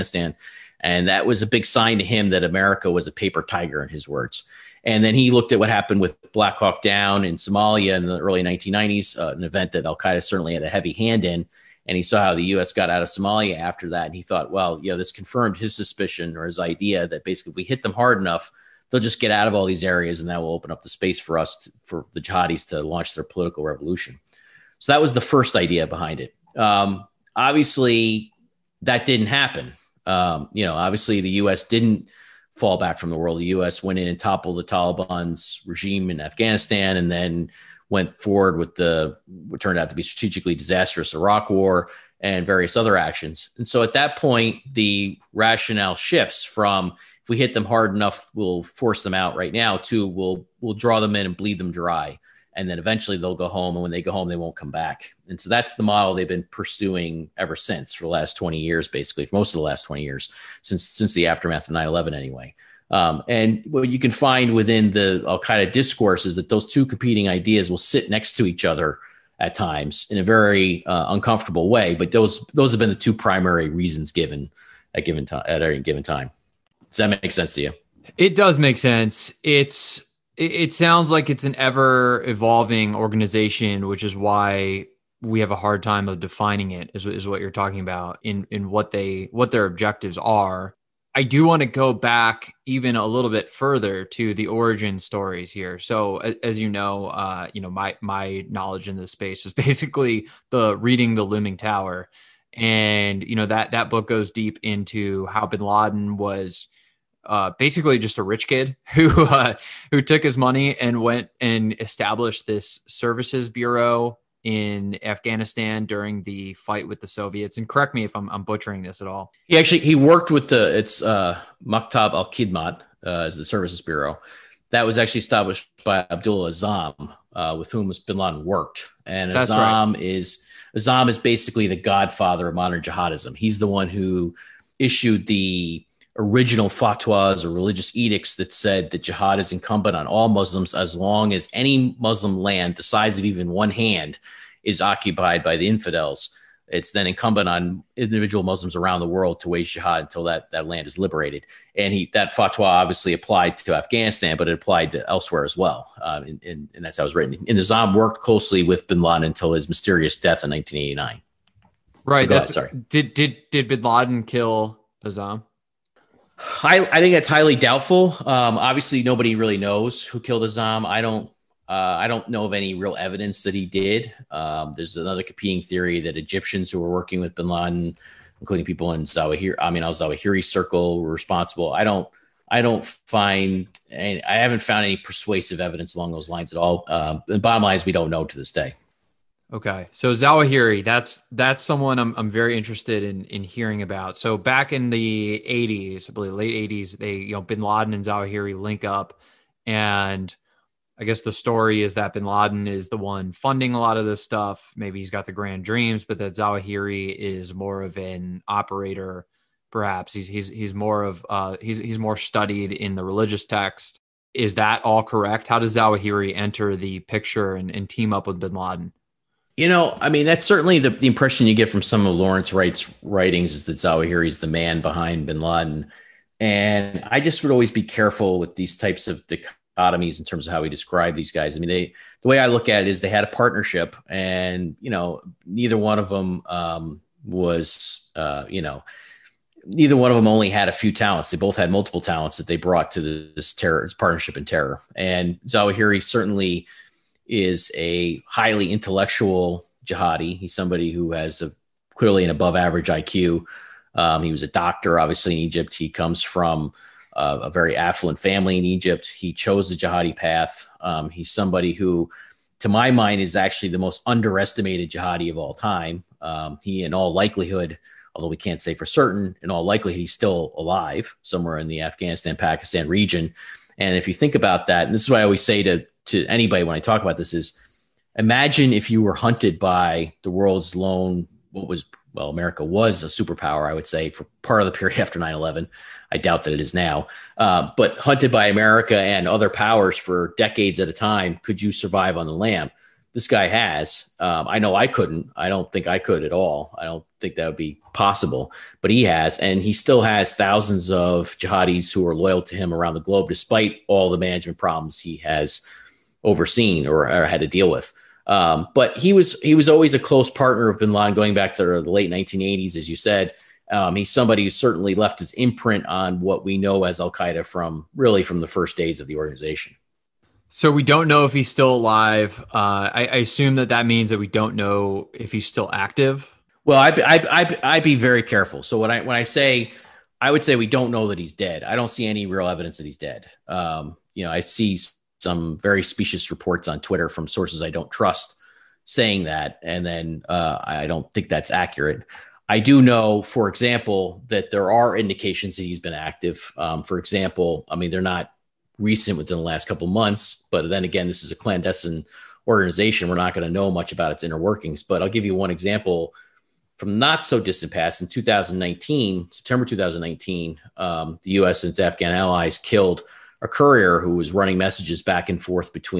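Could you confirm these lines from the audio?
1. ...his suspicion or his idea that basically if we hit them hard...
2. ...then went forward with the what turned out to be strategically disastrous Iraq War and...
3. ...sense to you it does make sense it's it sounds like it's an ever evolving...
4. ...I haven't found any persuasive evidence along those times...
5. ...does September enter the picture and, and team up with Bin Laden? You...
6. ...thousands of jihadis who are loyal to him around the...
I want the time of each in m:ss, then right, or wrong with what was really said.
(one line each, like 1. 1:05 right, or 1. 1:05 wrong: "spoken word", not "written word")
1. 0:15 right
2. 0:37 right
3. 1:17 right
4. 3:04 wrong: "lines", not "times"
5. 3:35 wrong: "Zawahiri", not "September"
6. 5:00 right.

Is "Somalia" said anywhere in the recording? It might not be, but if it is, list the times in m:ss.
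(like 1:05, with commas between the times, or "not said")
0:07, 0:13.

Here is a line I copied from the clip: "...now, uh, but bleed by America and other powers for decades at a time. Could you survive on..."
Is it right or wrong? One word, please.
wrong.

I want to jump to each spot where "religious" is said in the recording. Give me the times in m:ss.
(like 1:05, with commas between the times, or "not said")
2:17, 3:33.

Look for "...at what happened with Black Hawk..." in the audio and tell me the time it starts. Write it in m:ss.
0:05.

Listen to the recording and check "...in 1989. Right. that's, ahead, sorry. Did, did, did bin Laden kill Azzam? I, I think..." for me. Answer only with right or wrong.
right.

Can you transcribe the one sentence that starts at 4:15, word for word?
He comes from uh, a very affluent family in Egypt.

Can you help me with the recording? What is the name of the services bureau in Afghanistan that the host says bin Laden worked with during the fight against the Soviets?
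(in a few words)
Maktab al Khidmat.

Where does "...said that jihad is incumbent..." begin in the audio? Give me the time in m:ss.
2:18.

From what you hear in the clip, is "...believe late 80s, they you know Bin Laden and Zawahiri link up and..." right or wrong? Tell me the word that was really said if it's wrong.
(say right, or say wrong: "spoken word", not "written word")
right.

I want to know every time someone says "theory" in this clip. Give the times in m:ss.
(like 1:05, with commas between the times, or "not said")
2:55.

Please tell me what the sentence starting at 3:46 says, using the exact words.
And I just would always be careful with these types of dichotomies in terms of how we describe these guys.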